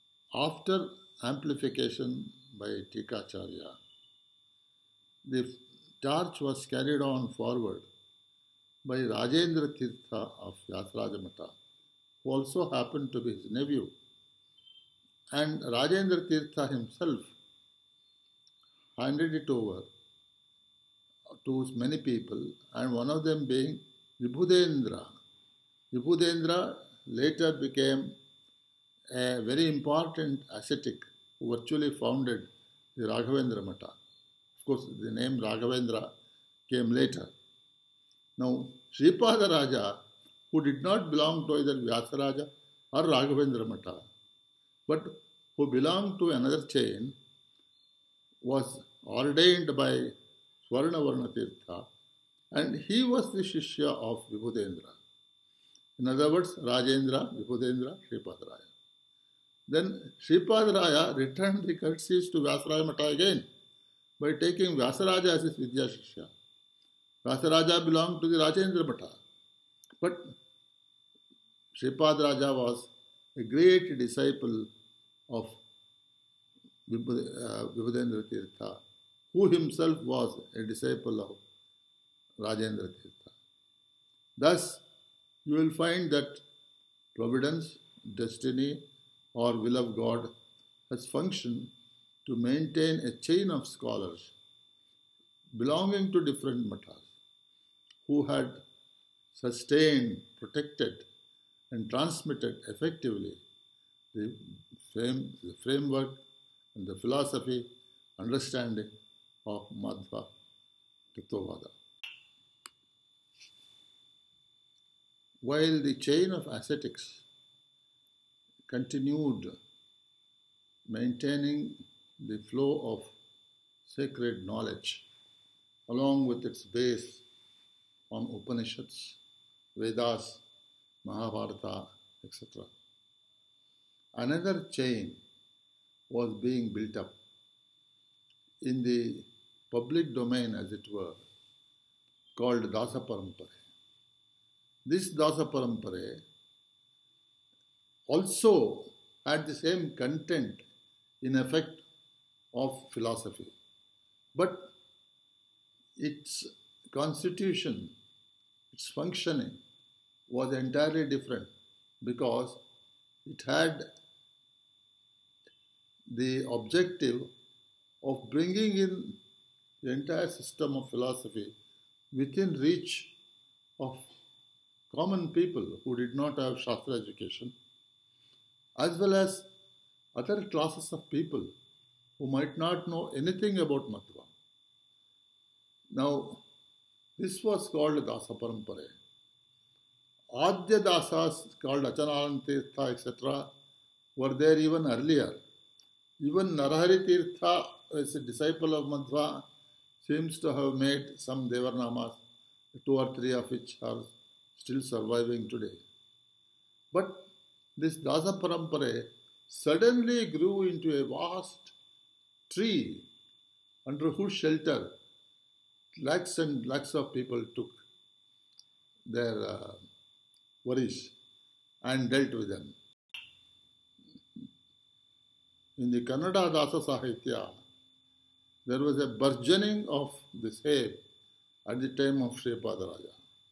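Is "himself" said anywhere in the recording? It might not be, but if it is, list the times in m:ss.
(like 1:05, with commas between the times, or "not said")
0:16, 1:19.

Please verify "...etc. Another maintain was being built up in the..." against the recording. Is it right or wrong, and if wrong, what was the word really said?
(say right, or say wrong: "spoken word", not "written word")
wrong: "chain", not "maintain".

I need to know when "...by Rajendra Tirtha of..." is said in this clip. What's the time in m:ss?
0:08.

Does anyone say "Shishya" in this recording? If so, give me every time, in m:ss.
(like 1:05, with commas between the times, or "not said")
0:53, 1:05.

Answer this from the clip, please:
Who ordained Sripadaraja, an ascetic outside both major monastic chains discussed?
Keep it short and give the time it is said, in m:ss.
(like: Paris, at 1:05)
Swarnavarna Tirtha, at 0:50.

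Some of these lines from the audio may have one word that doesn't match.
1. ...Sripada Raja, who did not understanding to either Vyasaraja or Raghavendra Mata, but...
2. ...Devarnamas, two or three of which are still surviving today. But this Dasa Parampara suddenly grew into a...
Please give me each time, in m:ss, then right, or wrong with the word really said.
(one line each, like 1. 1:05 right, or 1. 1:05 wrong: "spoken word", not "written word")
1. 0:38 wrong: "belong", not "understanding"
2. 3:21 right.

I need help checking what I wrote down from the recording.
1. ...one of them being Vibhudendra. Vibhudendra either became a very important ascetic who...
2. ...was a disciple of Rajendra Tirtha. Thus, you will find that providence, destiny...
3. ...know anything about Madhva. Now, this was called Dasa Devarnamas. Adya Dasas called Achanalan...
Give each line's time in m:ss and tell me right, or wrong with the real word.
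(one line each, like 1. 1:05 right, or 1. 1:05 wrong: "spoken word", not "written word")
1. 0:22 wrong: "later", not "either"
2. 1:20 right
3. 3:02 wrong: "Parampara", not "Devarnamas".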